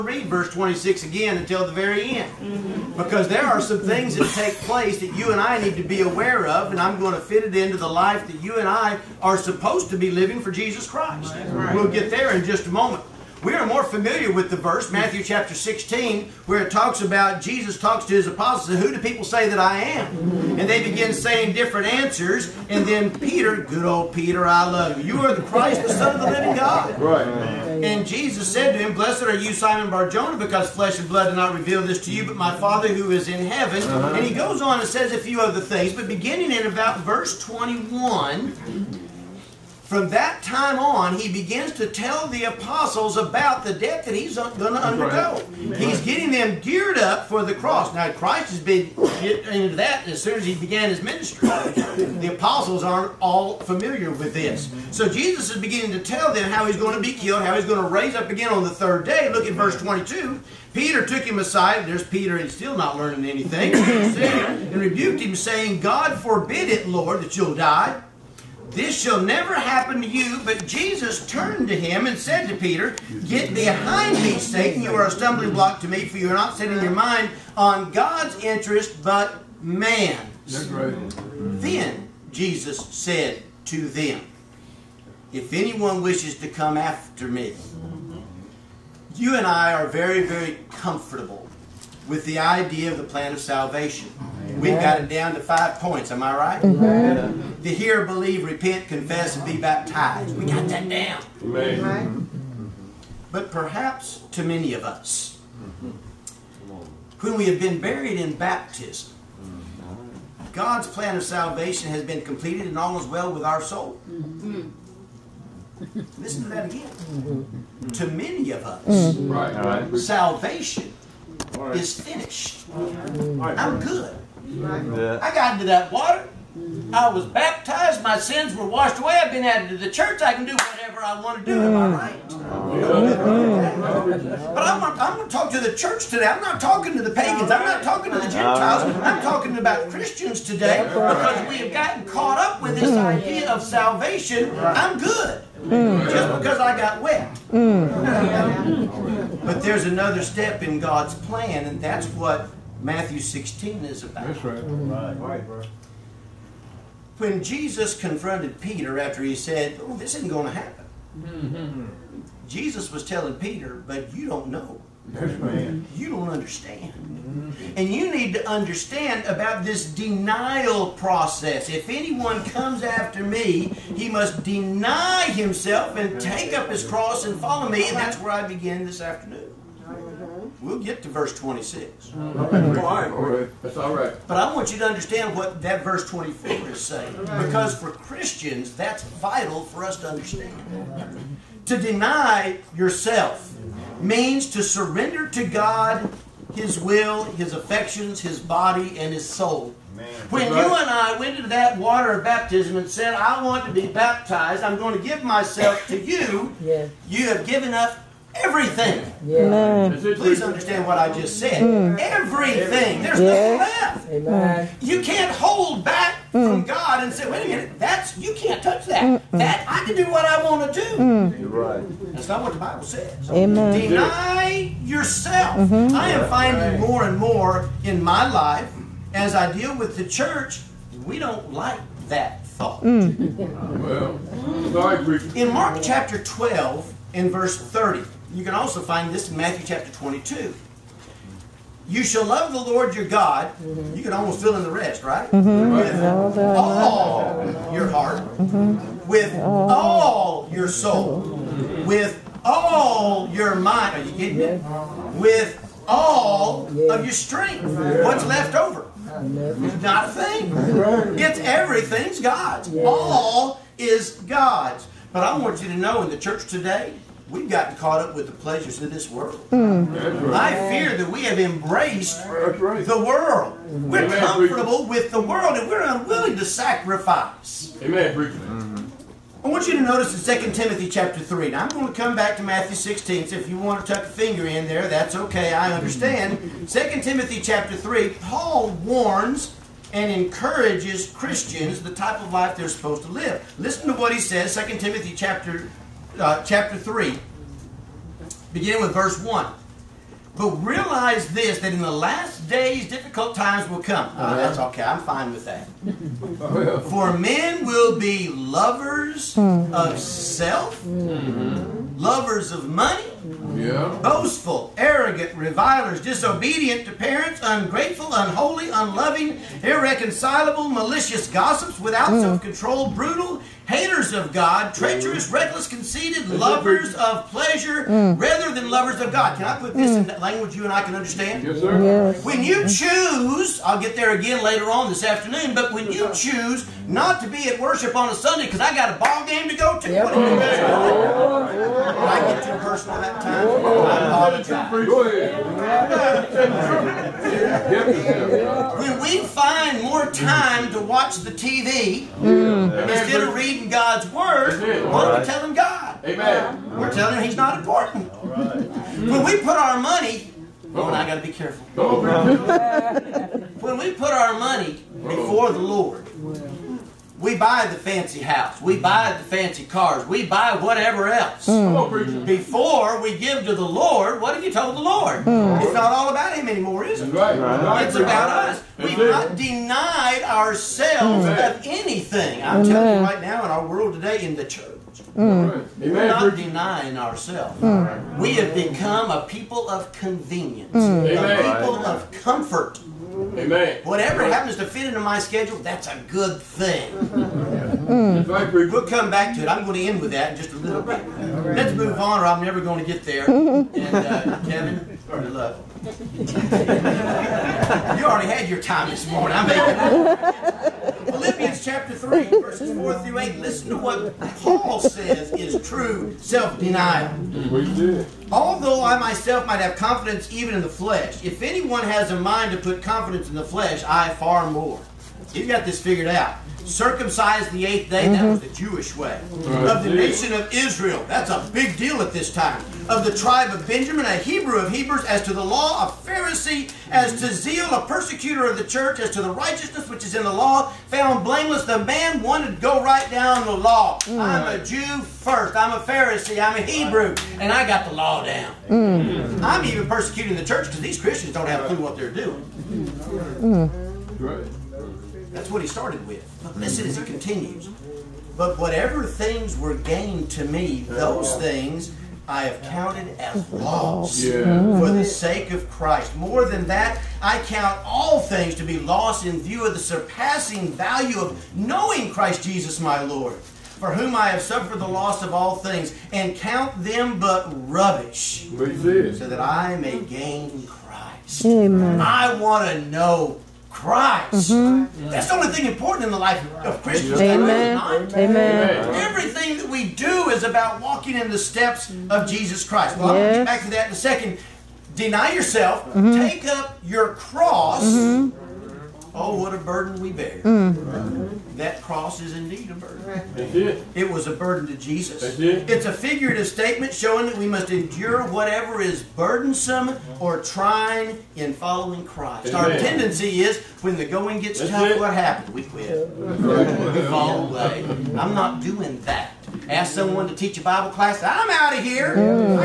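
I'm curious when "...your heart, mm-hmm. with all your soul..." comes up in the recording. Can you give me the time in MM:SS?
04:07.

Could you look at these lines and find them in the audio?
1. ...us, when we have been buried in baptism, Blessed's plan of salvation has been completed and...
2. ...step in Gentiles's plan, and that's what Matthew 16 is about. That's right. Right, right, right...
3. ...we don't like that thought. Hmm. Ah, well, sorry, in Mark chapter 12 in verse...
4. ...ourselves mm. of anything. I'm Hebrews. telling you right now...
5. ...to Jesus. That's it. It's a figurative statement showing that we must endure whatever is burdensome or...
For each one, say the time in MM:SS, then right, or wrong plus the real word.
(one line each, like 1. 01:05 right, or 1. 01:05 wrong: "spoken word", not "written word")
1. 01:44 wrong: "God", not "Blessed"
2. 02:30 wrong: "God", not "Gentiles"
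3. 03:51 right
4. 06:20 wrong: "Amen", not "Hebrews"
5. 08:24 right.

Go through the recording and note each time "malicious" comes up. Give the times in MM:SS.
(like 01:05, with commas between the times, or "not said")
05:20.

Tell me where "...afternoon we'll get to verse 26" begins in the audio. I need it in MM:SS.
02:58.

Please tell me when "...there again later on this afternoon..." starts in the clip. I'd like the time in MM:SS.
05:33.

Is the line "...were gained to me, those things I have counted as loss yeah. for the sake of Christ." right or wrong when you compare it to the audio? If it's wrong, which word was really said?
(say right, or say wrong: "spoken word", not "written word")
right.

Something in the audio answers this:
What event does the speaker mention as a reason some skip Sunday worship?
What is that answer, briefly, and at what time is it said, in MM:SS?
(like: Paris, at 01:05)
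A ball game, at 05:38.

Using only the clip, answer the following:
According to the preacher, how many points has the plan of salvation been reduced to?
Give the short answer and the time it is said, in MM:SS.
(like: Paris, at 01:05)
5, at 01:35.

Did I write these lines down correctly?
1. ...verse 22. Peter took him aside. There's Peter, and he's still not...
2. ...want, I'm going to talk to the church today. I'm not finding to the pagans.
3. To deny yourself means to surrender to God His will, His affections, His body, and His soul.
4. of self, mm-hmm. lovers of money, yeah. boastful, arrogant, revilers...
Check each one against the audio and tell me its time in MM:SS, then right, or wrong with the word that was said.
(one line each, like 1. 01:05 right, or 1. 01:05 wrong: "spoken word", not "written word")
1. 00:59 right
2. 02:14 wrong: "talking", not "finding"
3. 03:11 right
4. 05:09 right.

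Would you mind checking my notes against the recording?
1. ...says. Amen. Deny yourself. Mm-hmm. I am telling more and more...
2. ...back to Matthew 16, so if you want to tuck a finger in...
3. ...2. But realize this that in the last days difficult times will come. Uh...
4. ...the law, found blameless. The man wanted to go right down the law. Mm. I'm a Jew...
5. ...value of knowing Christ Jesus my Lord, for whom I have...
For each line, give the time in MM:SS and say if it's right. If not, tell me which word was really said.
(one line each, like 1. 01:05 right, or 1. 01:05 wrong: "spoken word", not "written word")
1. 03:42 wrong: "finding", not "telling"
2. 04:42 right
3. 04:59 wrong: "1", not "2"
4. 07:20 right
5. 07:50 right.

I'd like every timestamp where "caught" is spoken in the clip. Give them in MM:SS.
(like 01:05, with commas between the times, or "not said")
02:22, 04:27.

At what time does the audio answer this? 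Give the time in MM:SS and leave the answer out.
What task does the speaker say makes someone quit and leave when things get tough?
08:40.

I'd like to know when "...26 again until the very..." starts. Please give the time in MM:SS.
00:00.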